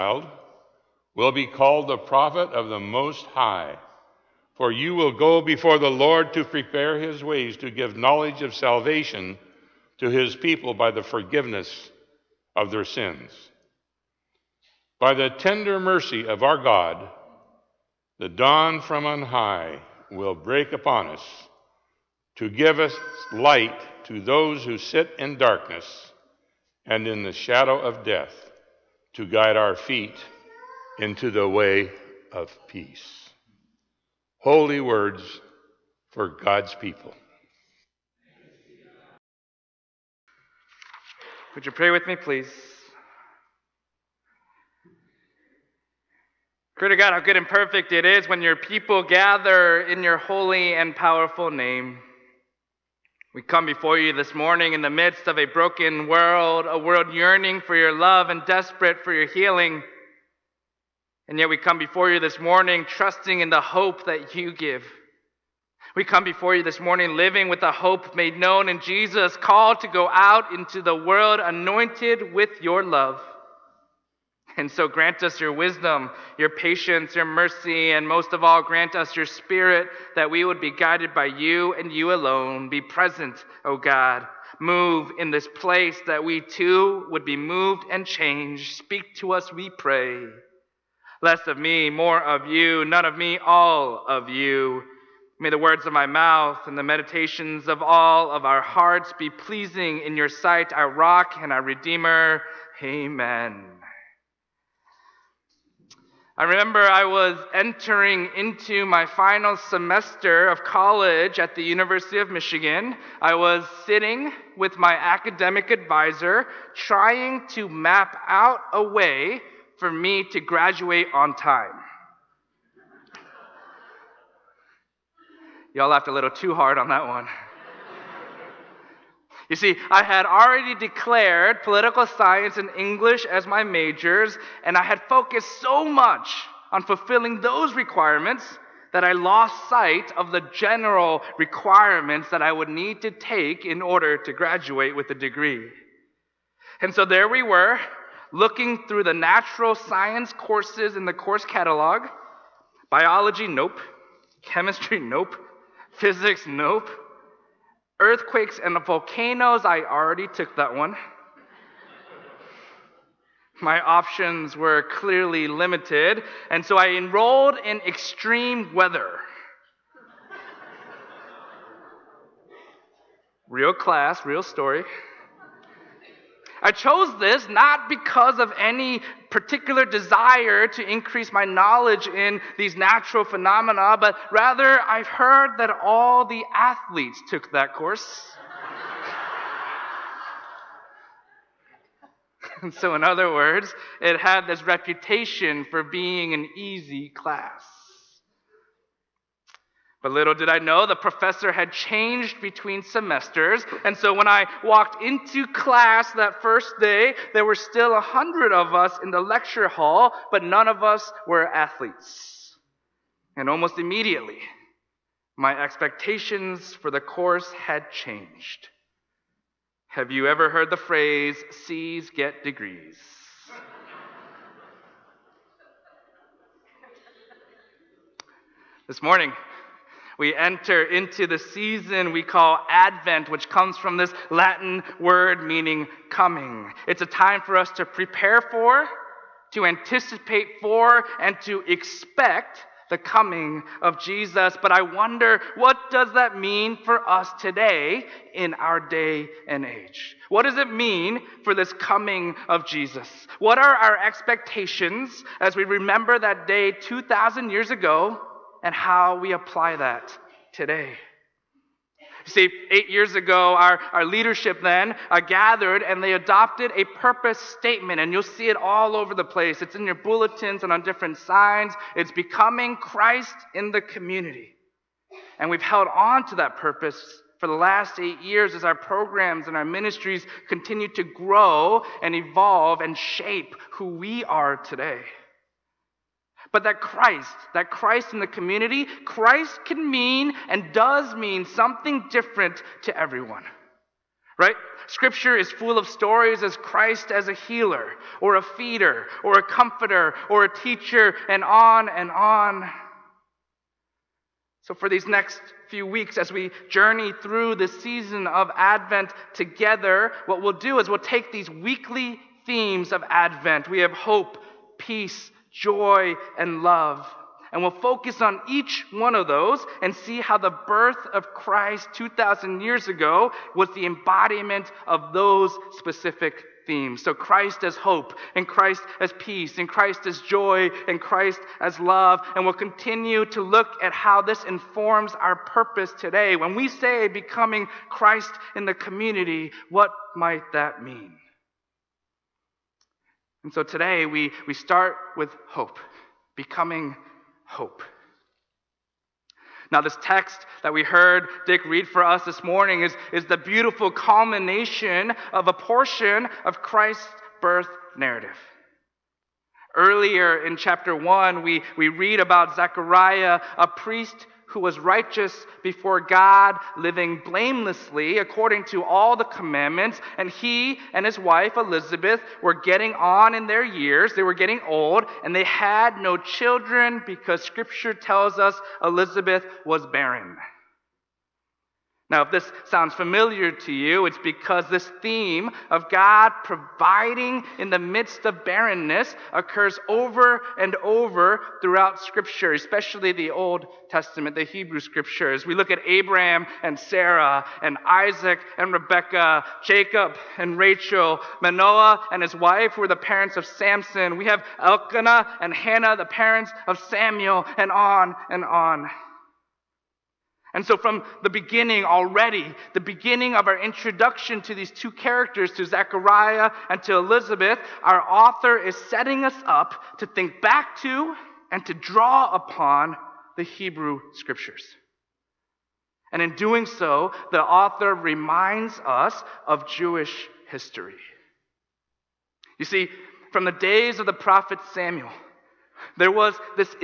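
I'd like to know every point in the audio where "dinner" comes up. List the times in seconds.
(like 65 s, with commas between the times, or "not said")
not said.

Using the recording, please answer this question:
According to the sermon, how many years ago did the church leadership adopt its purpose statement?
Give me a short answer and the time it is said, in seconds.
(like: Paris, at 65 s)
8, at 262 s.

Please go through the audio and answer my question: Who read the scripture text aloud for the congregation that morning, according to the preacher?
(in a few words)
Dick.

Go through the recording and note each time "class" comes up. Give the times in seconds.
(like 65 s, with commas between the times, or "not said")
173 s, 197 s, 205 s.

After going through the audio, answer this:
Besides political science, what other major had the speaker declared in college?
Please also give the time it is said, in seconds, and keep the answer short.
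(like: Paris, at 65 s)
English, at 132 s.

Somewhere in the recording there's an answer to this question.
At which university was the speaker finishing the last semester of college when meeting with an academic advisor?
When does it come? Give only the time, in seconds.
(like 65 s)
111 s.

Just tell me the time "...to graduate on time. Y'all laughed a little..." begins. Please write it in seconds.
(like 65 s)
120 s.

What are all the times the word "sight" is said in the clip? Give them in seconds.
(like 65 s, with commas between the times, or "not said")
100 s, 139 s.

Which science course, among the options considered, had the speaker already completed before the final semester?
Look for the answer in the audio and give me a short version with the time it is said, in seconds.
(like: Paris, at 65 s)
Earthquakes and volcanoes, at 157 s.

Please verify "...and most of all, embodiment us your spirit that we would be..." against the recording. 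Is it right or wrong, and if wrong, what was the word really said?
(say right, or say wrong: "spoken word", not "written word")
wrong: "grant", not "embodiment".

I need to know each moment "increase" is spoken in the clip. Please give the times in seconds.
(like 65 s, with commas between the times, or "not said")
180 s.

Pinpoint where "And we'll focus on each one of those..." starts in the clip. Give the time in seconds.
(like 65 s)
317 s.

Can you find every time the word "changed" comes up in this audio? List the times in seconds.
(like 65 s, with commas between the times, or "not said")
88 s, 201 s, 217 s.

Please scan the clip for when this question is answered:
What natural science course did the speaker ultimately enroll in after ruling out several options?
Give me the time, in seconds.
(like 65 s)
167 s.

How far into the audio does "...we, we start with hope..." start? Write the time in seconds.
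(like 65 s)
344 s.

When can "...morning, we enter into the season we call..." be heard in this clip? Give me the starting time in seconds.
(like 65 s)
229 s.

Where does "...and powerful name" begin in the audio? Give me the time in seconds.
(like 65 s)
50 s.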